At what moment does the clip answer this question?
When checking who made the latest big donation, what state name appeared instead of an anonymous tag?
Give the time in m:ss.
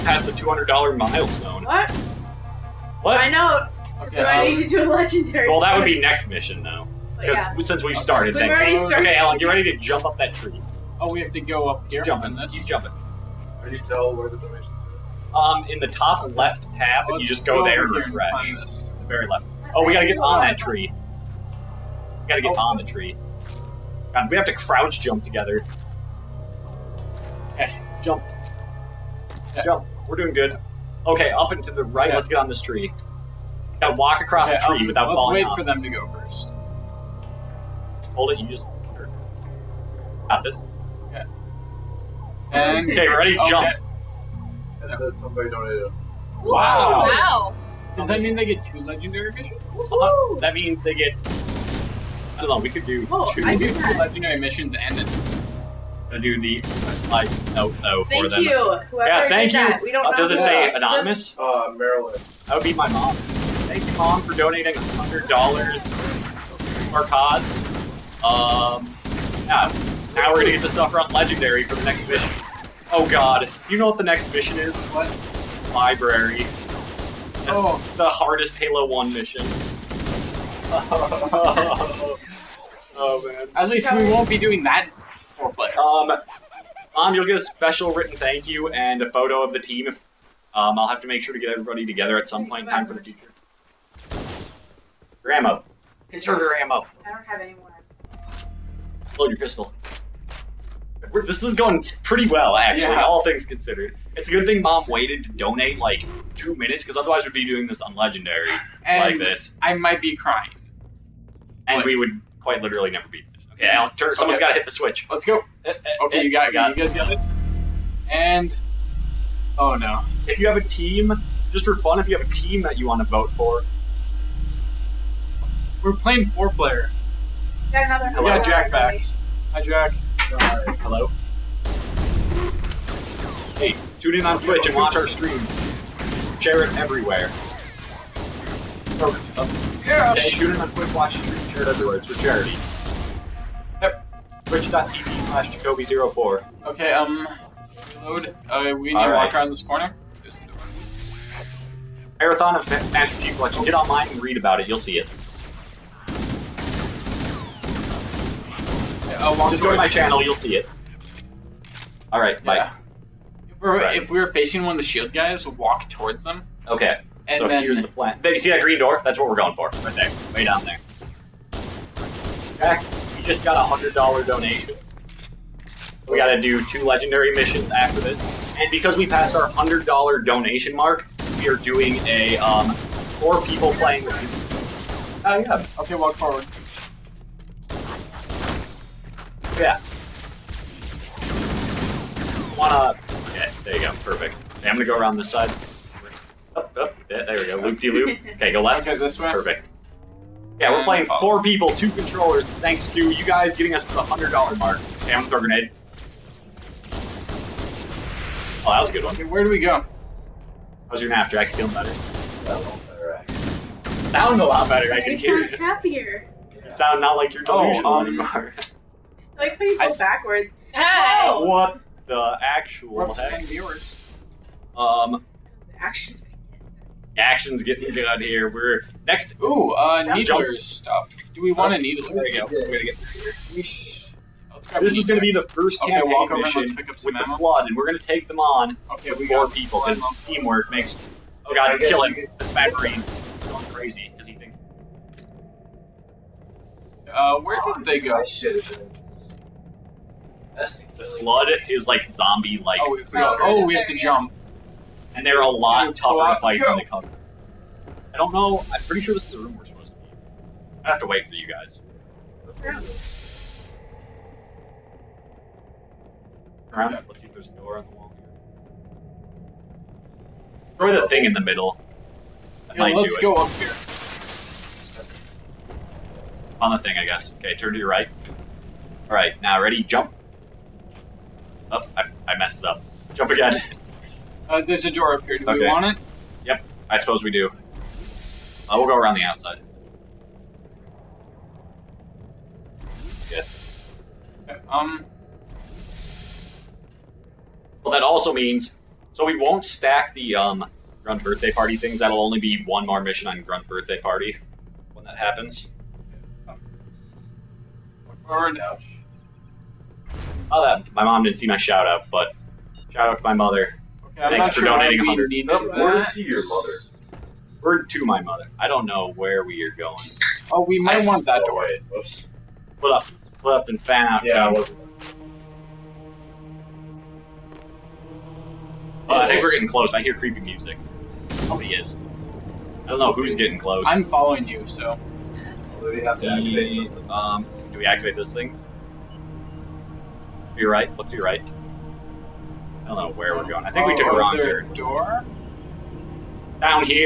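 1:01.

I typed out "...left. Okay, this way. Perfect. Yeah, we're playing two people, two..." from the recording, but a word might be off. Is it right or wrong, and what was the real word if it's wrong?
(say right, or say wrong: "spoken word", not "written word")
wrong: "four", not "two".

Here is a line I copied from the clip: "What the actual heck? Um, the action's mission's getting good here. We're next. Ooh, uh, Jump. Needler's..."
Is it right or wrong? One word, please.
wrong.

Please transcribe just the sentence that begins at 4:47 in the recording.
Uh, we'll go around the outside.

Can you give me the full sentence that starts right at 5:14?
Okay, I'm not for sure donating we 100.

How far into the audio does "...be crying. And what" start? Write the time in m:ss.
1:50.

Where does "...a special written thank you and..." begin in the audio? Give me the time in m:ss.
1:27.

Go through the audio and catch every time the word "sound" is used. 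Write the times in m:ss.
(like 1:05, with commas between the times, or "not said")
3:32, 3:36.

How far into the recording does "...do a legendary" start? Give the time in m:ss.
0:04.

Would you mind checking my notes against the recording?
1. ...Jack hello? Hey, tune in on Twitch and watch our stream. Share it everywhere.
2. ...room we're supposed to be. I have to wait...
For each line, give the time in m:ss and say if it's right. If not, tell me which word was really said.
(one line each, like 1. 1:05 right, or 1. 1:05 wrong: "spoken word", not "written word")
1. 2:09 right
2. 4:19 right.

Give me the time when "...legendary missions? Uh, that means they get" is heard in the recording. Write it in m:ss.
0:48.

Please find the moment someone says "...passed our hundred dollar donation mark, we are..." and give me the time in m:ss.
2:59.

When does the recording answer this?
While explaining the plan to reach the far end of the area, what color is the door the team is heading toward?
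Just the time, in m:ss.
2:48.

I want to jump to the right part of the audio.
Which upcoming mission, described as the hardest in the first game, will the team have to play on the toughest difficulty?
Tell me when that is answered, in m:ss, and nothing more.
1:15.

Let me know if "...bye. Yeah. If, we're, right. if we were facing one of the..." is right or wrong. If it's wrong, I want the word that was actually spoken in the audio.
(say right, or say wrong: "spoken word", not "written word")
right.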